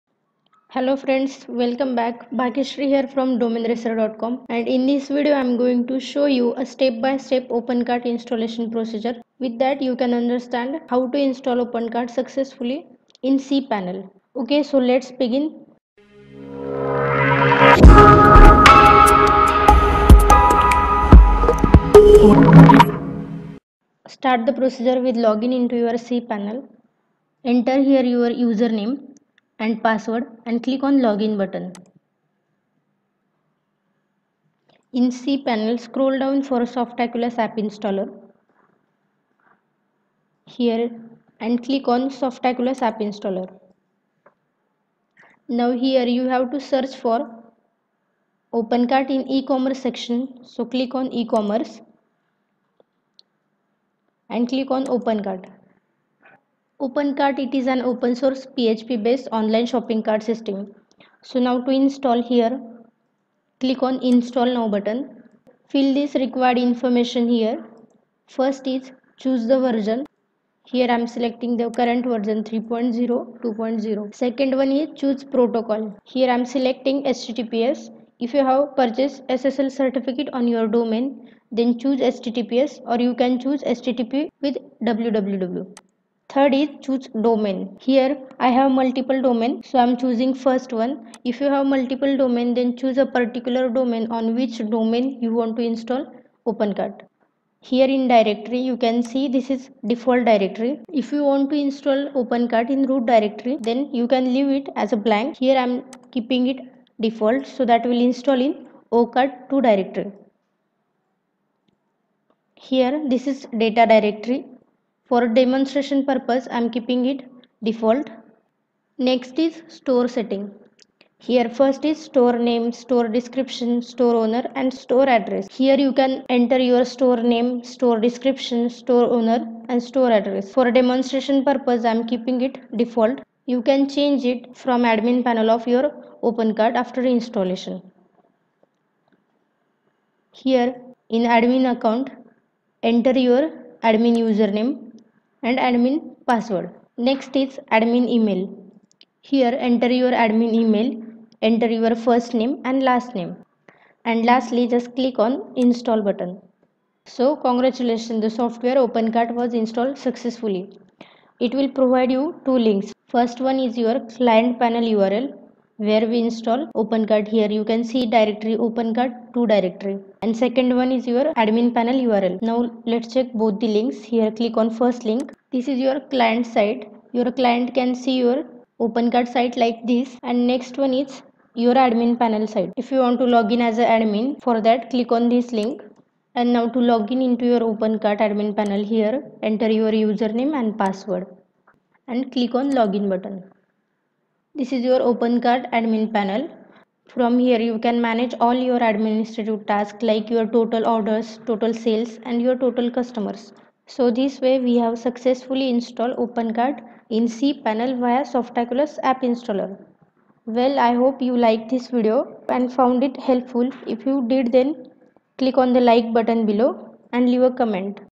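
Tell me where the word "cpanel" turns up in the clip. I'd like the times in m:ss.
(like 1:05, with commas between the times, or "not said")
0:13, 0:26, 0:35, 3:27.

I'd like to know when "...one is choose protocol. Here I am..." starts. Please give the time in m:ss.
1:14.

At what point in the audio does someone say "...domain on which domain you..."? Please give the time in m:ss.
1:33.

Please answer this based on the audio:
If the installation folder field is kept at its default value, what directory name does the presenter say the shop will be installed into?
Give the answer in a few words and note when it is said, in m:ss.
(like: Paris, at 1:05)
ocart2, at 1:49.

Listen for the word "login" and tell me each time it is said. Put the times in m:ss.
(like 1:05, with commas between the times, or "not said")
0:25, 0:31, 3:12.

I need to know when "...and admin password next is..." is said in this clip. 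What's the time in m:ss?
2:25.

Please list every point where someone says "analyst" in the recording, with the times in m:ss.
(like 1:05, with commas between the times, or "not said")
not said.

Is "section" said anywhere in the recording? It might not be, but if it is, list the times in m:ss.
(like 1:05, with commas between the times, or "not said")
0:49.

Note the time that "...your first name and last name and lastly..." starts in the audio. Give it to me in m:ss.
2:31.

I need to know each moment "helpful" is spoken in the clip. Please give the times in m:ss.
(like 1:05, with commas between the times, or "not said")
3:33.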